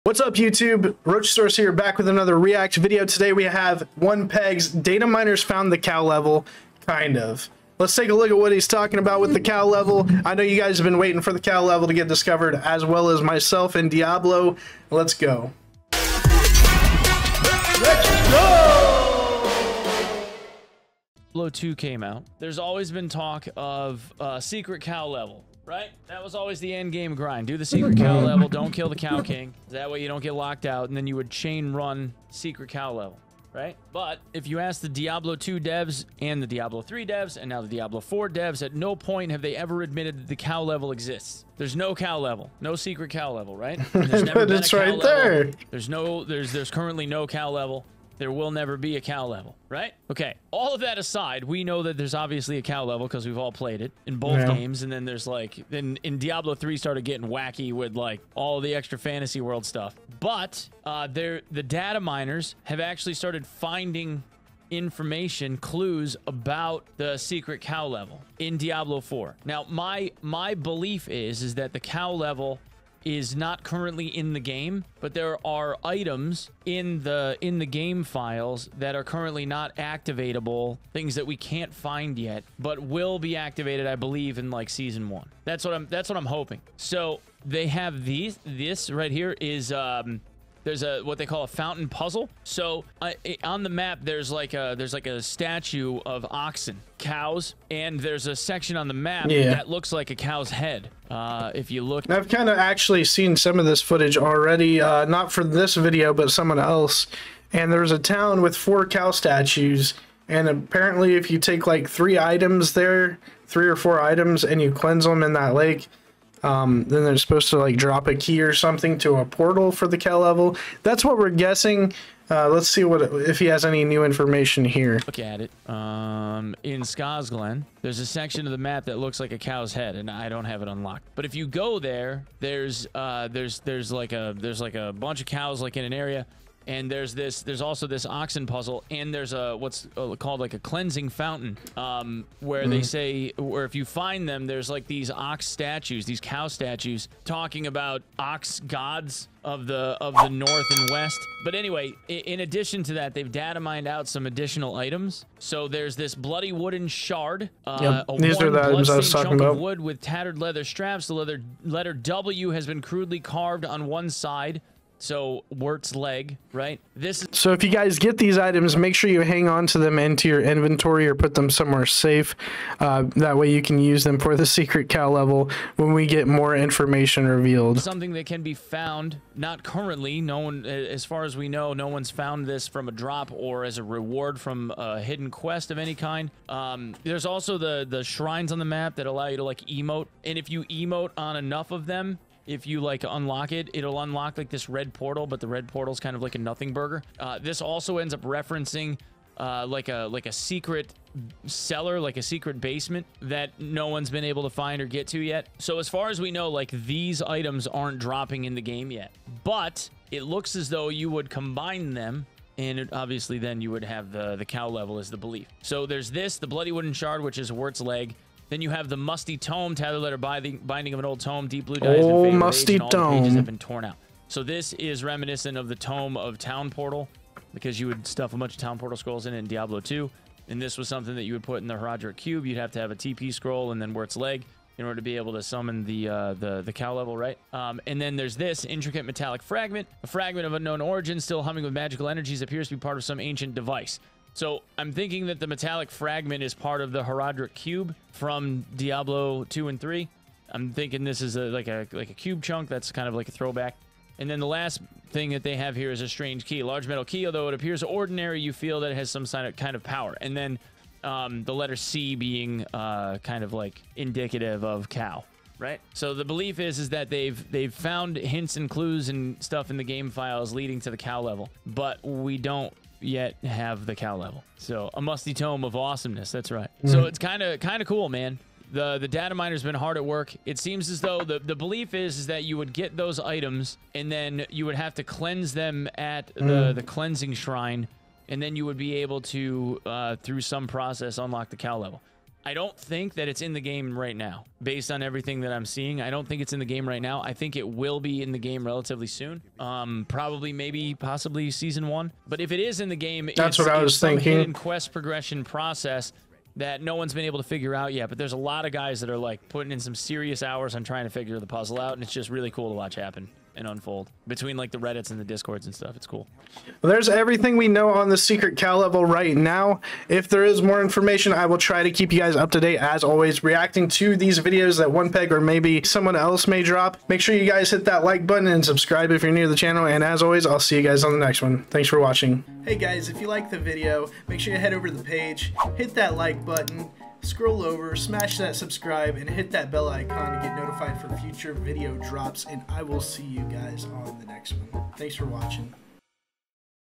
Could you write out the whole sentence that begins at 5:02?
But if it is in the game, that's what I was thinking.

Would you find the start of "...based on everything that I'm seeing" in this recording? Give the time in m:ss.
4:54.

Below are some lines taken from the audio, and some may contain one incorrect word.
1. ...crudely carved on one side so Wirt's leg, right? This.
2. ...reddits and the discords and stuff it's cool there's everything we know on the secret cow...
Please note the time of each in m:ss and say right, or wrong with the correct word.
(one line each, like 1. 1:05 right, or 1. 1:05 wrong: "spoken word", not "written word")
1. 2:42 right
2. 5:14 right.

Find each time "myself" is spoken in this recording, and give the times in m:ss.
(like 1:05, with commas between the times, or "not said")
0:13.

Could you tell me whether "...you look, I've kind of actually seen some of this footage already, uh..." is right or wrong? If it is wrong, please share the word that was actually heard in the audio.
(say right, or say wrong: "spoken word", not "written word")
right.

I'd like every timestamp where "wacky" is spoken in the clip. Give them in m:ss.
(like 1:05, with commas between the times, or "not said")
0:57.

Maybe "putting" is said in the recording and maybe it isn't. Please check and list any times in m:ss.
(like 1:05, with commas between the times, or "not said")
5:09.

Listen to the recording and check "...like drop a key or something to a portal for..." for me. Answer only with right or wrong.
right.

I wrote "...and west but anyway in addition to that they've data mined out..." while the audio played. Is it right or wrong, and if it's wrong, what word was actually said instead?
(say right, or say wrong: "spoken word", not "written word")
right.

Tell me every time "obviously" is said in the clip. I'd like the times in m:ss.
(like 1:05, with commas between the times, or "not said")
0:52, 3:32.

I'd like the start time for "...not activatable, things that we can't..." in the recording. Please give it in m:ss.
1:19.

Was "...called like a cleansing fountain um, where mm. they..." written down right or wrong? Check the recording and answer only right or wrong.
right.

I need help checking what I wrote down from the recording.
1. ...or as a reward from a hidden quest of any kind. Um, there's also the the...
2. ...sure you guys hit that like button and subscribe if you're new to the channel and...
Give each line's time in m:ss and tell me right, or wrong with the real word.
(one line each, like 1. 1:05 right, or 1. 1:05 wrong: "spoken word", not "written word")
1. 3:03 right
2. 5:27 right.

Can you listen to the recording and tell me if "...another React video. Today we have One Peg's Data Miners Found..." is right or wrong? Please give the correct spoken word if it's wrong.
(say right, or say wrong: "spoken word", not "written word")
right.